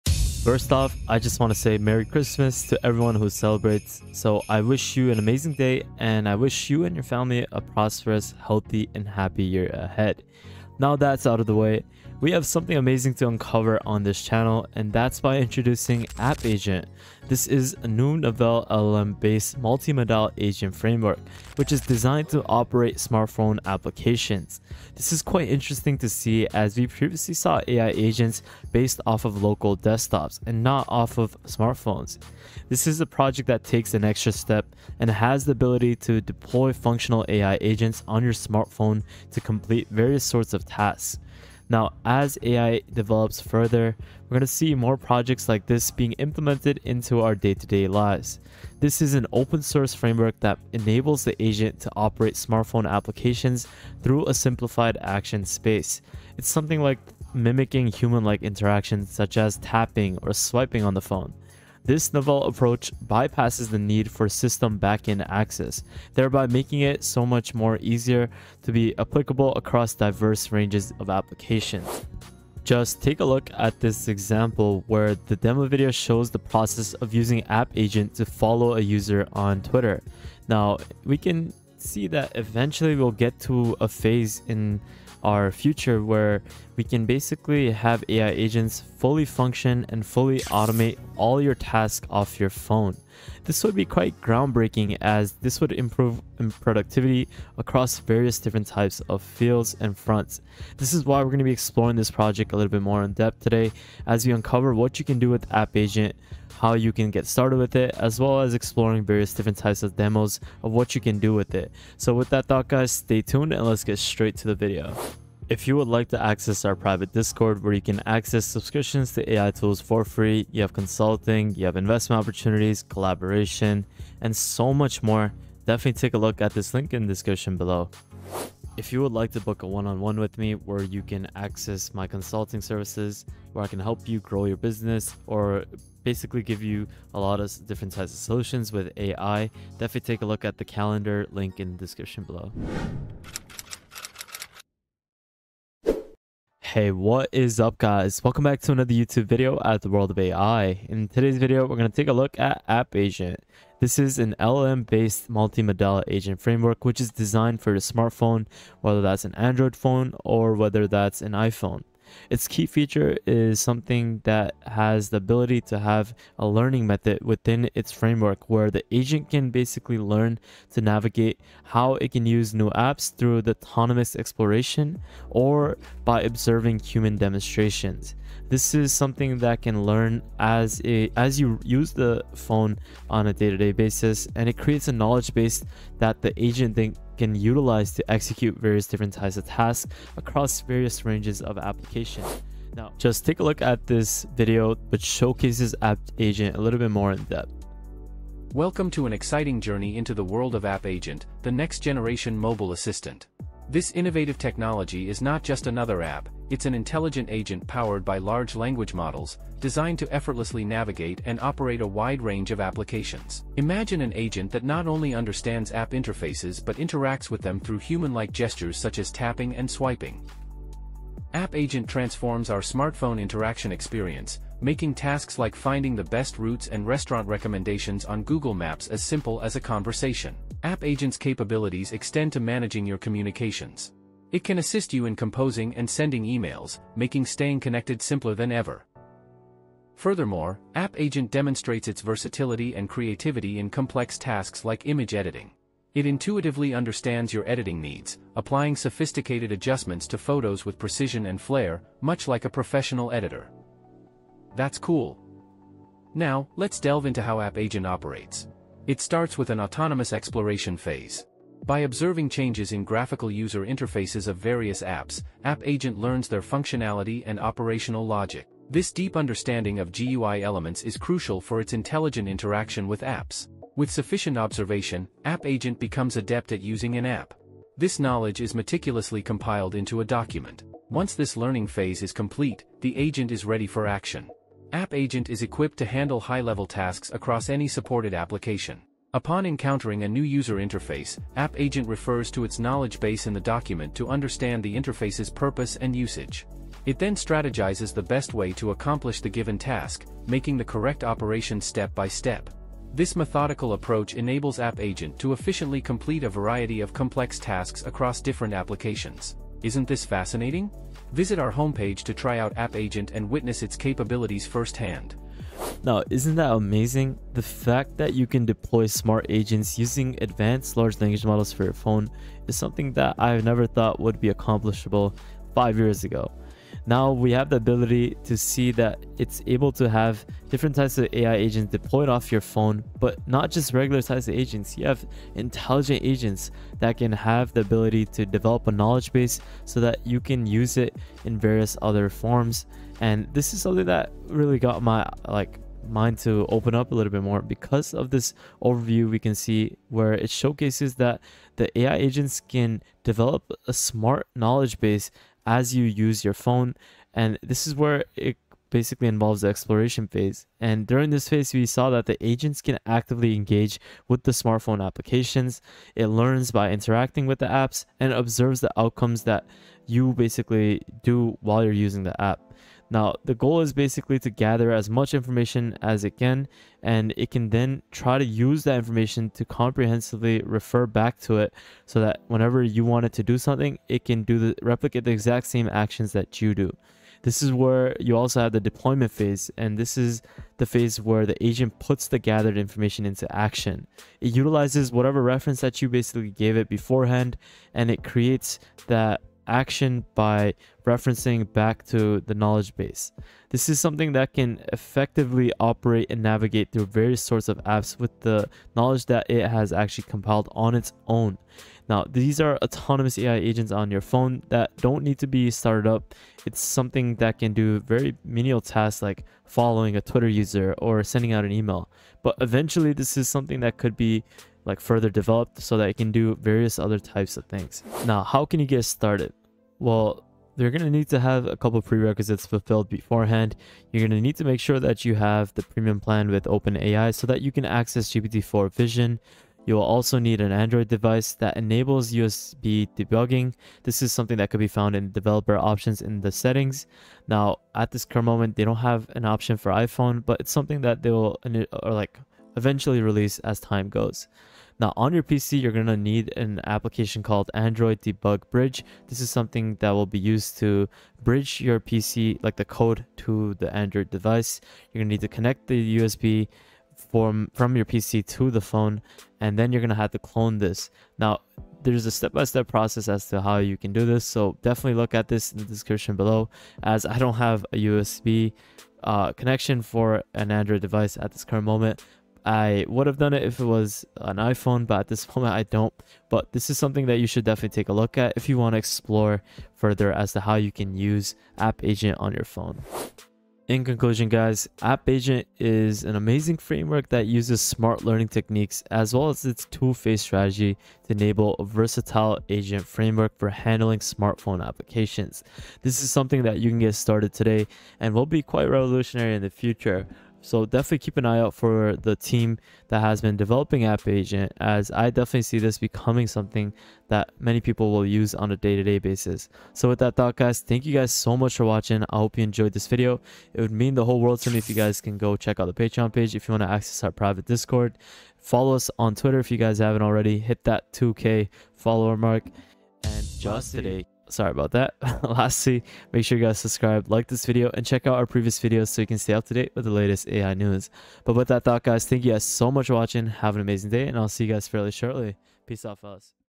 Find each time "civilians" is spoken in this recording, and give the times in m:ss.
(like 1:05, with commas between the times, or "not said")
not said.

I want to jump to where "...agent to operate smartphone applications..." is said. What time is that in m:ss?
0:51.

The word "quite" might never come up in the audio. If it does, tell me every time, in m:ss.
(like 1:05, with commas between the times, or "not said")
0:25, 1:33, 8:28.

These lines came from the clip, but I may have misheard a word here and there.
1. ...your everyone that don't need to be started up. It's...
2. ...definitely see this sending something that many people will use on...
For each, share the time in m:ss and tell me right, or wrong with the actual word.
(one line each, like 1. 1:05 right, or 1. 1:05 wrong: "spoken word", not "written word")
1. 6:53 wrong: "phone", not "everyone"
2. 8:35 wrong: "becoming", not "sending".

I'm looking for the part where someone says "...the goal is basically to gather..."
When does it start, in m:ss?
6:13.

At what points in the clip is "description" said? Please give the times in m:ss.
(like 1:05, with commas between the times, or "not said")
2:07, 2:21, 7:55.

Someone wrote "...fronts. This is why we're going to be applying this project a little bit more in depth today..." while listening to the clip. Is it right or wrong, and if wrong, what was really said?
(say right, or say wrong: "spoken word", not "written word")
wrong: "exploring", not "applying".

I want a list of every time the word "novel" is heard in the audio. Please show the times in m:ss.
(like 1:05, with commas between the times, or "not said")
0:18, 1:02.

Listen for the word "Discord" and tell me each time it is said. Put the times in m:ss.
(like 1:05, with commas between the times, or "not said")
1:57, 8:47.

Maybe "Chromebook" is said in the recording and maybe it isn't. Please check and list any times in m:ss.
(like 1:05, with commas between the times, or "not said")
not said.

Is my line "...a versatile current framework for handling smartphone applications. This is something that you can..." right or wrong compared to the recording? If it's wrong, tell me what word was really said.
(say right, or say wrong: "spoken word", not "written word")
wrong: "agent", not "current".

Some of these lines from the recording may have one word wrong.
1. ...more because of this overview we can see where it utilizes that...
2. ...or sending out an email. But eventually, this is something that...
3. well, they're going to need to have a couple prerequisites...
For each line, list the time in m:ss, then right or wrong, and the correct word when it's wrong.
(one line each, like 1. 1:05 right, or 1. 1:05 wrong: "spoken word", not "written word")
1. 5:47 wrong: "showcases", not "utilizes"
2. 7:00 right
3. 7:09 right.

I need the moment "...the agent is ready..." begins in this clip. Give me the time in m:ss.
4:42.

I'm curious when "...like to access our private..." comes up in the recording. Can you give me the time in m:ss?
1:55.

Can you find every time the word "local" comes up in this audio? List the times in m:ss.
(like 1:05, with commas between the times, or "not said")
0:29.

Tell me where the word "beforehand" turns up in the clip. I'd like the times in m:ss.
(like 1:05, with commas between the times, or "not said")
6:36, 7:12.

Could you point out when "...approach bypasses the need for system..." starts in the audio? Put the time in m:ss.
1:02.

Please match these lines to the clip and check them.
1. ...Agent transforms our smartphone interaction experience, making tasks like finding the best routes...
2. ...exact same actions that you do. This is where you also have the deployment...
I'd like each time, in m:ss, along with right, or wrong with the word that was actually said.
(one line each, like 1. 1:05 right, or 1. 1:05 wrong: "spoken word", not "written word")
1. 3:41 right
2. 6:25 right.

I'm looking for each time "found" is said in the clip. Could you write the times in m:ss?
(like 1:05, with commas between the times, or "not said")
7:24.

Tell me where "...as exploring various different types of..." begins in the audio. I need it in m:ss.
1:48.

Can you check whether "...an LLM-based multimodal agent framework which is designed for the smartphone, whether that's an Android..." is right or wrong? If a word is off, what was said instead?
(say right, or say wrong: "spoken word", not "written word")
right.